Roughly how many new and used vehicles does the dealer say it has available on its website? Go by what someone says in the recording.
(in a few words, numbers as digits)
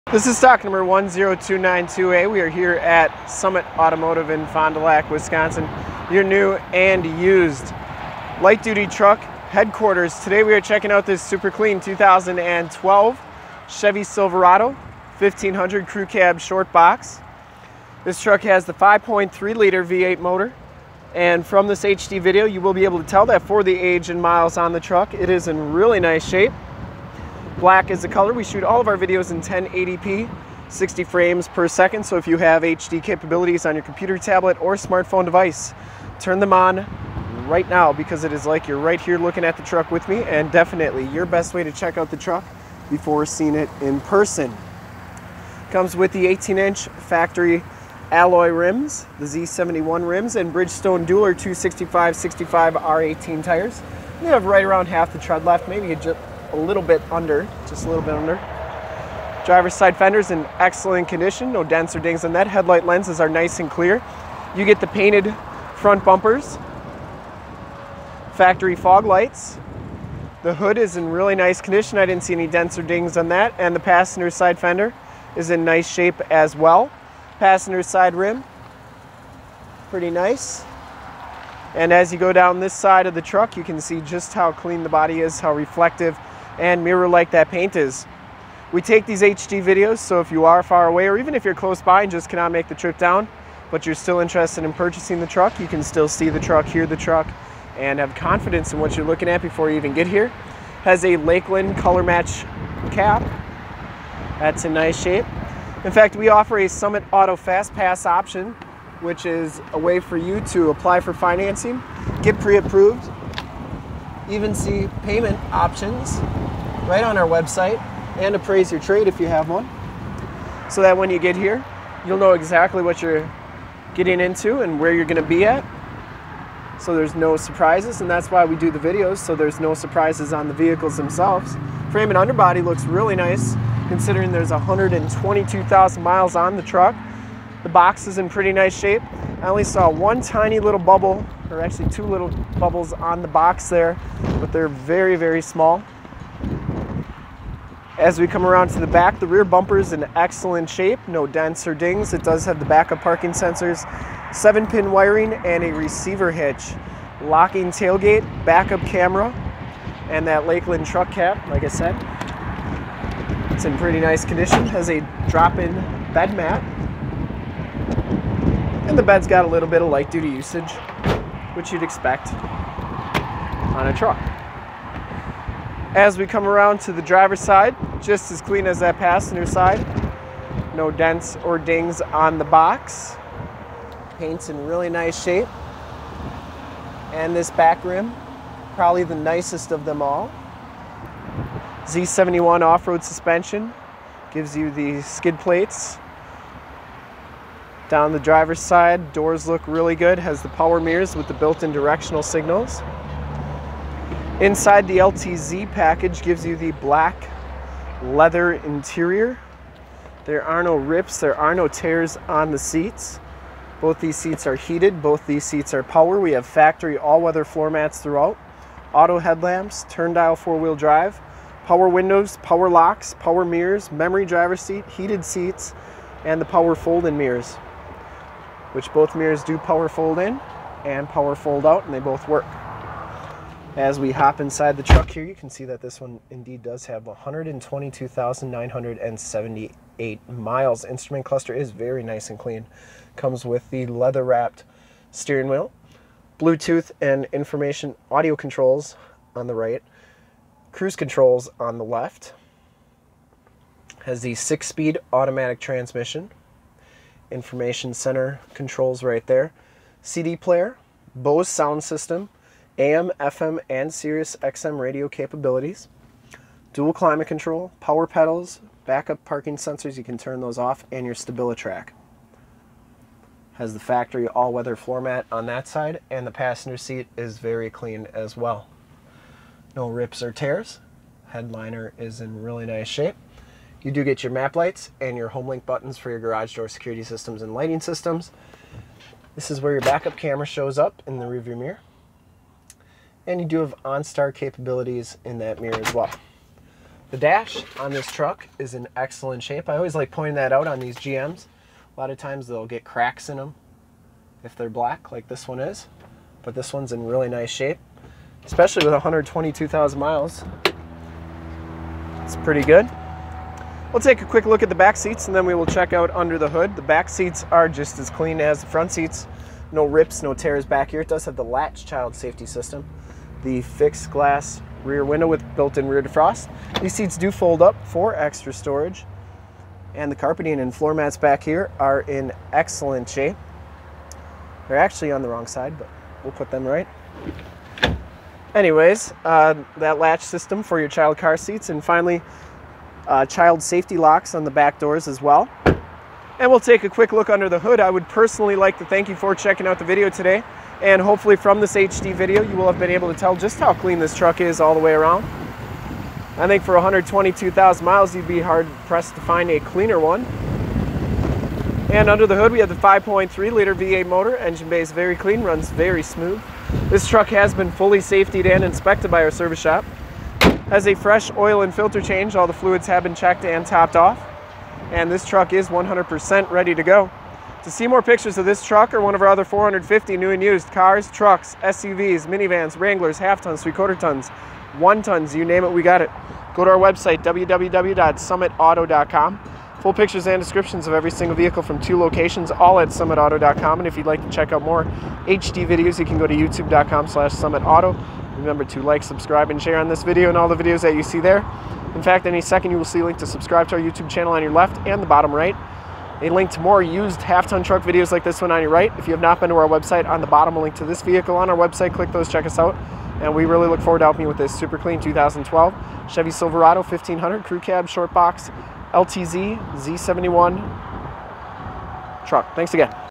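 450.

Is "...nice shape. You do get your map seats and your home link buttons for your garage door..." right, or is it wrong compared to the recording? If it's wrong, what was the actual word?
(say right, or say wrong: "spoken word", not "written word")
wrong: "lights", not "seats".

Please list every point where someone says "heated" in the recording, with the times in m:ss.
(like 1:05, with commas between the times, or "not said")
3:34, 3:44.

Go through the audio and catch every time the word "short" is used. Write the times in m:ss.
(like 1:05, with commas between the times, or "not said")
0:16, 6:57.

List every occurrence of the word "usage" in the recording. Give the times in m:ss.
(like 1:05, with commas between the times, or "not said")
2:50.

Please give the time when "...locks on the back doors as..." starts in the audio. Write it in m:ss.
5:43.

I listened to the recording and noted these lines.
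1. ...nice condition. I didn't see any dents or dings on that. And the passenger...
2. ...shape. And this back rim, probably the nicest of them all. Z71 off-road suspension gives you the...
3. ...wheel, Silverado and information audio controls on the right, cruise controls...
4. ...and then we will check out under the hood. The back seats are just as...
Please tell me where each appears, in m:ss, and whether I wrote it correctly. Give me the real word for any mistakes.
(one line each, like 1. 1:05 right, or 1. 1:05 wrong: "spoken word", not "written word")
1. 1:11 right
2. 3:05 right
3. 4:05 wrong: "Bluetooth", not "Silverado"
4. 5:15 right.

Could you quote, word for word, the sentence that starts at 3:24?
Inside the LTZ package gives you the black leather interior.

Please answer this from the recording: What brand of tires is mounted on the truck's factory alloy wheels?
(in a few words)
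Bridgestone Dueler.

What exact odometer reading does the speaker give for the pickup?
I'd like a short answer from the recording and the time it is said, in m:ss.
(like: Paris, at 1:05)
122,978 miles, at 3:57.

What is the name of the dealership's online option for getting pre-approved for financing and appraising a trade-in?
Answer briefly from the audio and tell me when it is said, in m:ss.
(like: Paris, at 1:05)
Summit Auto Fast Pass, at 1:46.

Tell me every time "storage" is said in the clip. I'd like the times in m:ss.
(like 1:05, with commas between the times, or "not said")
5:28.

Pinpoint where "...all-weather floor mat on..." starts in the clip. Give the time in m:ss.
4:34.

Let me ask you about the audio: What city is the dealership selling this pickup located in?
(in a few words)
Fond du Lac.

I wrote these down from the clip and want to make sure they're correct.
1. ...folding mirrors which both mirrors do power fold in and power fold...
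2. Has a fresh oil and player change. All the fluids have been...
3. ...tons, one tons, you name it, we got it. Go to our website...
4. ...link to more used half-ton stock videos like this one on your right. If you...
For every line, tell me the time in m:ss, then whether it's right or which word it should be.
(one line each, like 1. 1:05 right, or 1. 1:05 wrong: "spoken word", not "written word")
1. 3:46 right
2. 6:10 wrong: "filter", not "player"
3. 6:23 right
4. 6:46 wrong: "truck", not "stock".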